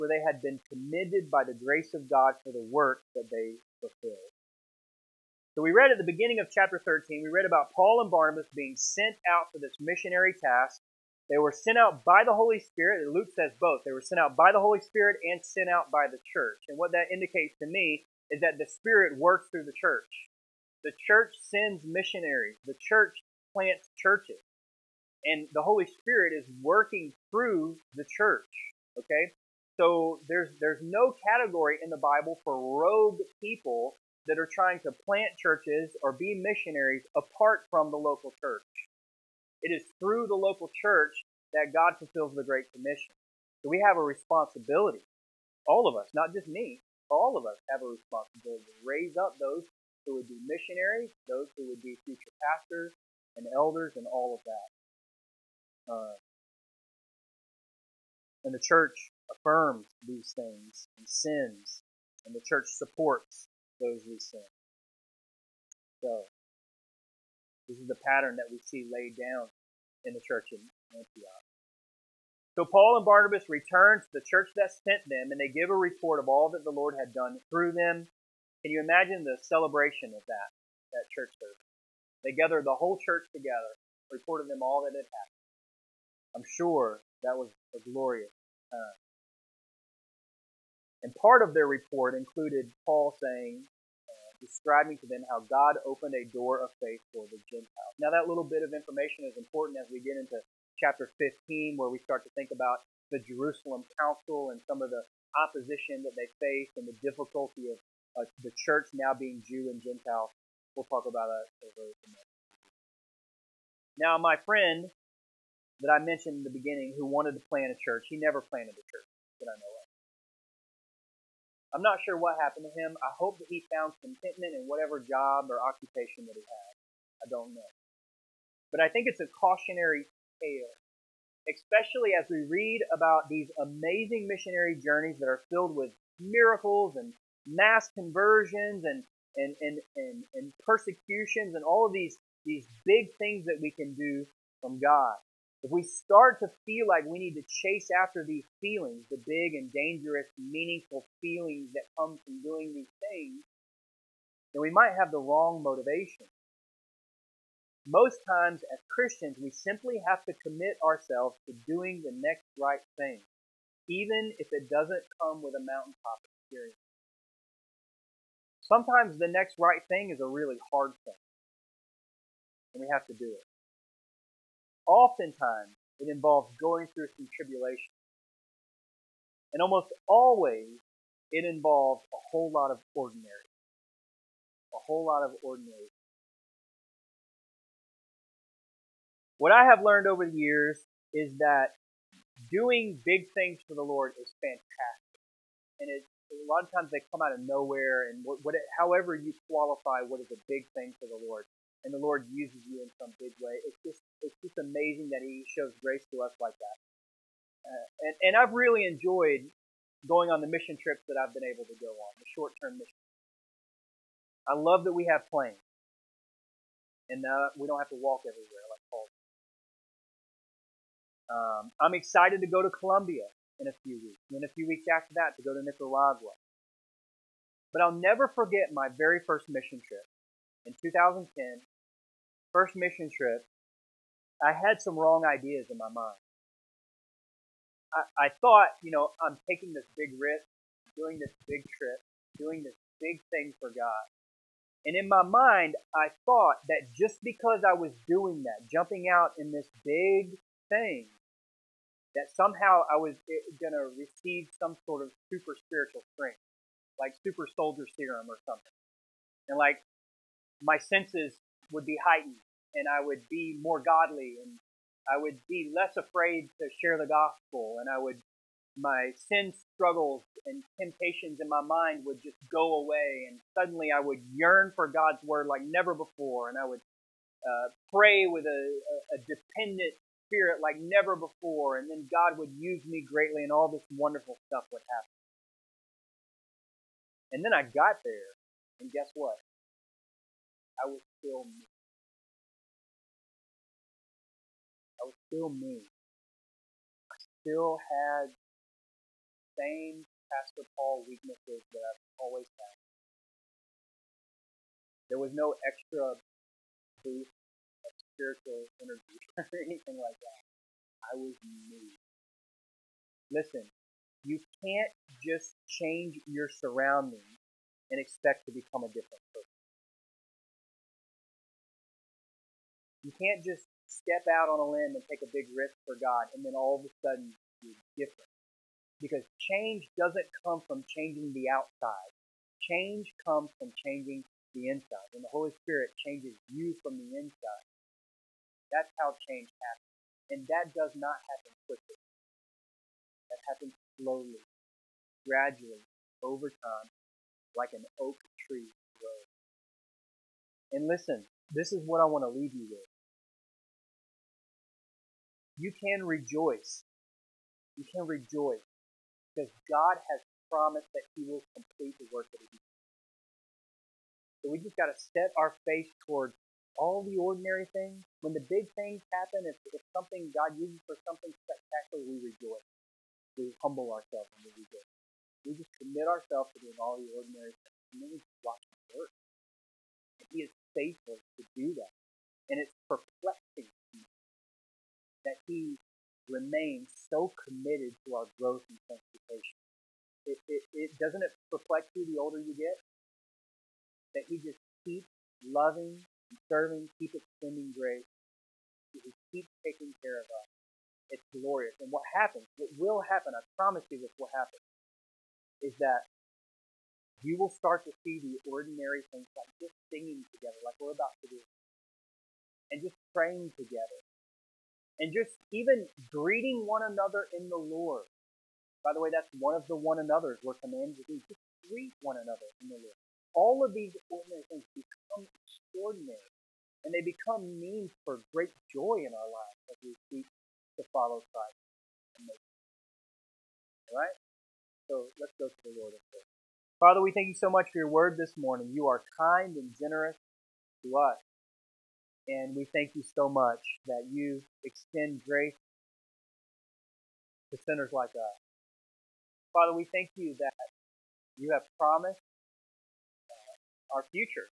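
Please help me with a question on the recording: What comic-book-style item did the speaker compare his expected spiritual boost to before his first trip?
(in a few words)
super soldier serum.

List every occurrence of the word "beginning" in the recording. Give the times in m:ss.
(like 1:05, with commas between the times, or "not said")
0:06, 1:56.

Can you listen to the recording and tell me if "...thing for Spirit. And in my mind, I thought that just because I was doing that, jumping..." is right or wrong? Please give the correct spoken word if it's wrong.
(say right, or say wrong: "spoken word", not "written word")
wrong: "God", not "Spirit".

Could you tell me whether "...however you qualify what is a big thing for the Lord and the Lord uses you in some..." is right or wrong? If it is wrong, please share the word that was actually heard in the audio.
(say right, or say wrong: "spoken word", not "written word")
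right.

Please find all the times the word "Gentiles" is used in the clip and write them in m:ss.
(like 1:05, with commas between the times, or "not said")
1:37, 1:49.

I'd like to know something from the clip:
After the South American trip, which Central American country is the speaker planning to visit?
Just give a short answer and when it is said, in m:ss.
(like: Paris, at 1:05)
Nicaragua, at 3:45.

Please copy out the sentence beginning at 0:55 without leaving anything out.
Uh, and the church affirms these things and sins, and the church supports those who sin.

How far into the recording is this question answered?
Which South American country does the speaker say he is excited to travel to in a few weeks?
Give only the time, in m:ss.
3:42.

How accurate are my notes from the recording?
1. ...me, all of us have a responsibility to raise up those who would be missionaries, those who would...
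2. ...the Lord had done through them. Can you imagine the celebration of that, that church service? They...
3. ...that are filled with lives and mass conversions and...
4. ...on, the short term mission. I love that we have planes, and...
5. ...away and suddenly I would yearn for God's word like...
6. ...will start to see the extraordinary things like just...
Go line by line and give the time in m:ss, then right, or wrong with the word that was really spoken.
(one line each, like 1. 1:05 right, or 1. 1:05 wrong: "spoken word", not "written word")
1. 0:46 right
2. 1:16 right
3. 2:15 wrong: "miracles", not "lives"
4. 3:31 right
5. 4:32 right
6. 6:47 wrong: "ordinary", not "extraordinary".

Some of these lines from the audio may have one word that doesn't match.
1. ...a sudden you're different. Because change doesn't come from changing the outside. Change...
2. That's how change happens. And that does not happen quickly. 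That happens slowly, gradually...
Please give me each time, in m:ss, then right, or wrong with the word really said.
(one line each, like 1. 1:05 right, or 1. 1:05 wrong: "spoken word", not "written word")
1. 5:26 right
2. 5:38 right.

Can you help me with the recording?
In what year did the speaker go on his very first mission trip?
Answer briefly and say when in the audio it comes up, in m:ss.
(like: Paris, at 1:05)
2010, at 3:50.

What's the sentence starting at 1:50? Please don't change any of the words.
We'll talk about that over the next.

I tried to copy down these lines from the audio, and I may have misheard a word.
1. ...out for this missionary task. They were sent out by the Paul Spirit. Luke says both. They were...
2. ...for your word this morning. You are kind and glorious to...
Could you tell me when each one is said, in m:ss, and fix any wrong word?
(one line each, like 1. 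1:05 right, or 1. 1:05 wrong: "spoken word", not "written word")
1. 0:09 wrong: "Holy", not "Paul"
2. 7:17 wrong: "generous", not "glorious".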